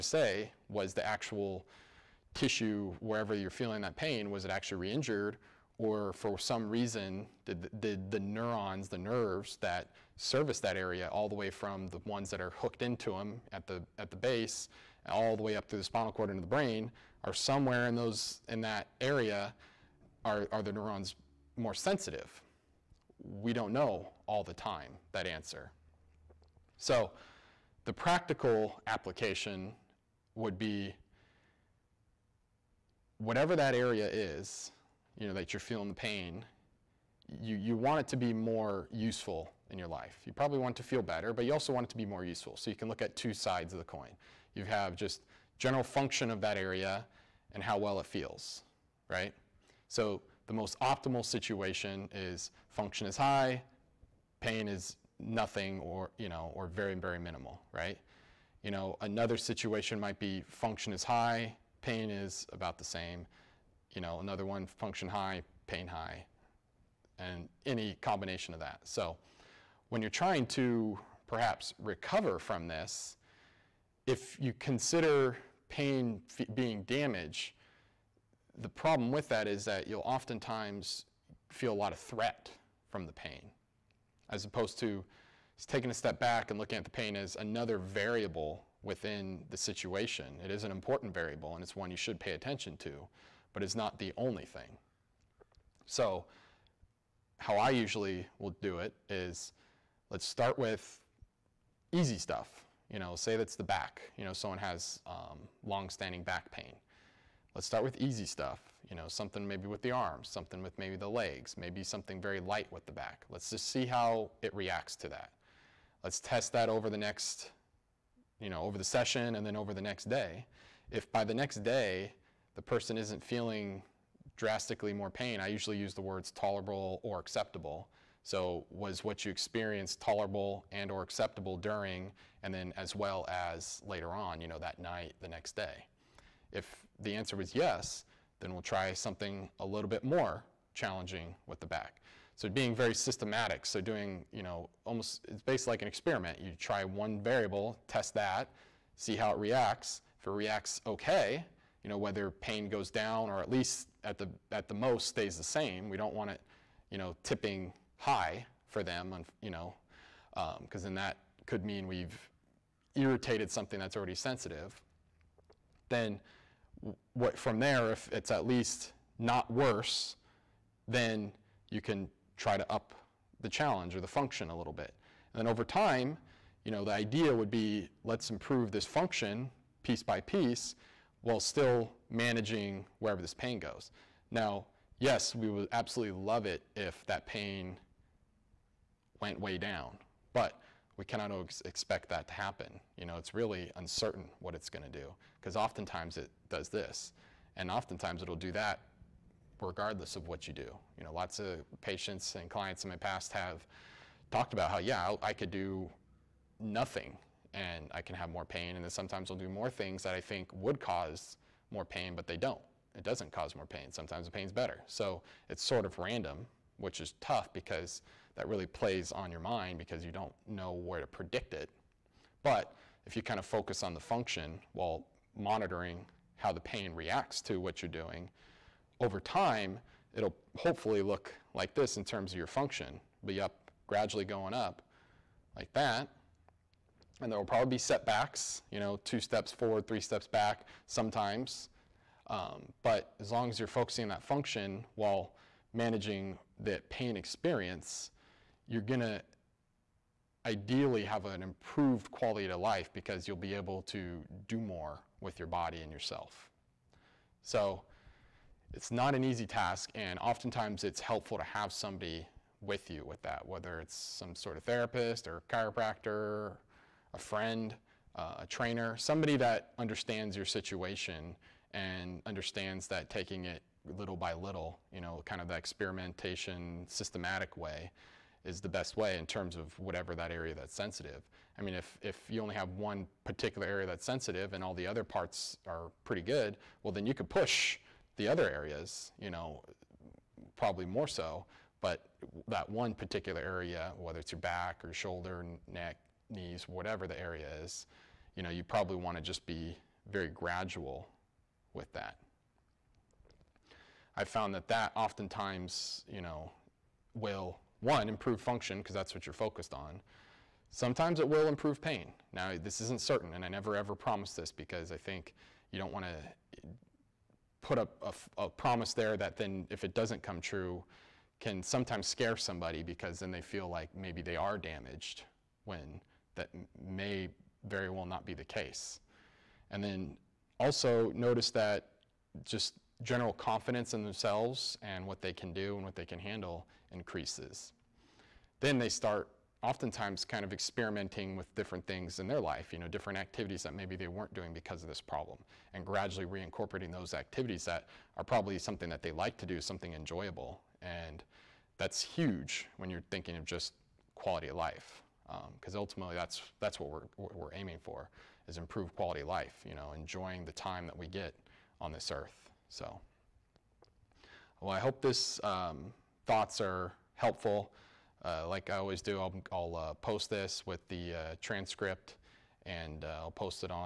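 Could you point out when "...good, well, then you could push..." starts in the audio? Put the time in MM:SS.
04:46.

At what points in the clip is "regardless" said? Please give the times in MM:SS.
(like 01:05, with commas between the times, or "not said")
03:19.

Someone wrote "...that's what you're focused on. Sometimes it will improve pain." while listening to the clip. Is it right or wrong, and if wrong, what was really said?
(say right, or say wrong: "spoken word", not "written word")
right.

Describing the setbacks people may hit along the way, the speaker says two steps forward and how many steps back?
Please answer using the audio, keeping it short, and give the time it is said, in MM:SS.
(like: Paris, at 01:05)
3 steps back, at 03:59.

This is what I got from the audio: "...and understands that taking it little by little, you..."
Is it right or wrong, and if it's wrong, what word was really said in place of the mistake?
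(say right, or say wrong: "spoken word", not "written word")
right.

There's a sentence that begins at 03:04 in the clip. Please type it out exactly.
Now, yes, we would absolutely love it if that pain went way down, but we cannot expect that to happen.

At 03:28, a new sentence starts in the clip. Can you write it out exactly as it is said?
And then sometimes I'll do more things that I think would cause more pain, but they don't.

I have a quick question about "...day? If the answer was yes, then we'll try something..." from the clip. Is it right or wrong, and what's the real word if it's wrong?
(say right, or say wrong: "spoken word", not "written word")
right.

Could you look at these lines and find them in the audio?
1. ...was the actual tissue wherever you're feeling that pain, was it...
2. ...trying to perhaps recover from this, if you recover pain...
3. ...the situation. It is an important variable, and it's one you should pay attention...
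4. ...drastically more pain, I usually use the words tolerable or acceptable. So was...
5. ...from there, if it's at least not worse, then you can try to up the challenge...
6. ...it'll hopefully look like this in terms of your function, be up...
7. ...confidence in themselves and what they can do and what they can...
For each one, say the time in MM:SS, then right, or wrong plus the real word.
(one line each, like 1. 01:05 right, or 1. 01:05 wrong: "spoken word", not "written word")
1. 00:00 right
2. 01:10 wrong: "consider", not "recover"
3. 01:29 right
4. 02:04 right
5. 02:47 right
6. 03:50 right
7. 05:33 right.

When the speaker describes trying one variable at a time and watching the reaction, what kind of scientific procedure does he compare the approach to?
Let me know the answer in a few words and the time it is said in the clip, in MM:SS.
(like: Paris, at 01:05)
an experiment, at 02:25.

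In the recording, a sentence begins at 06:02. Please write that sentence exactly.
So, well, I hope this um, thoughts are helpful.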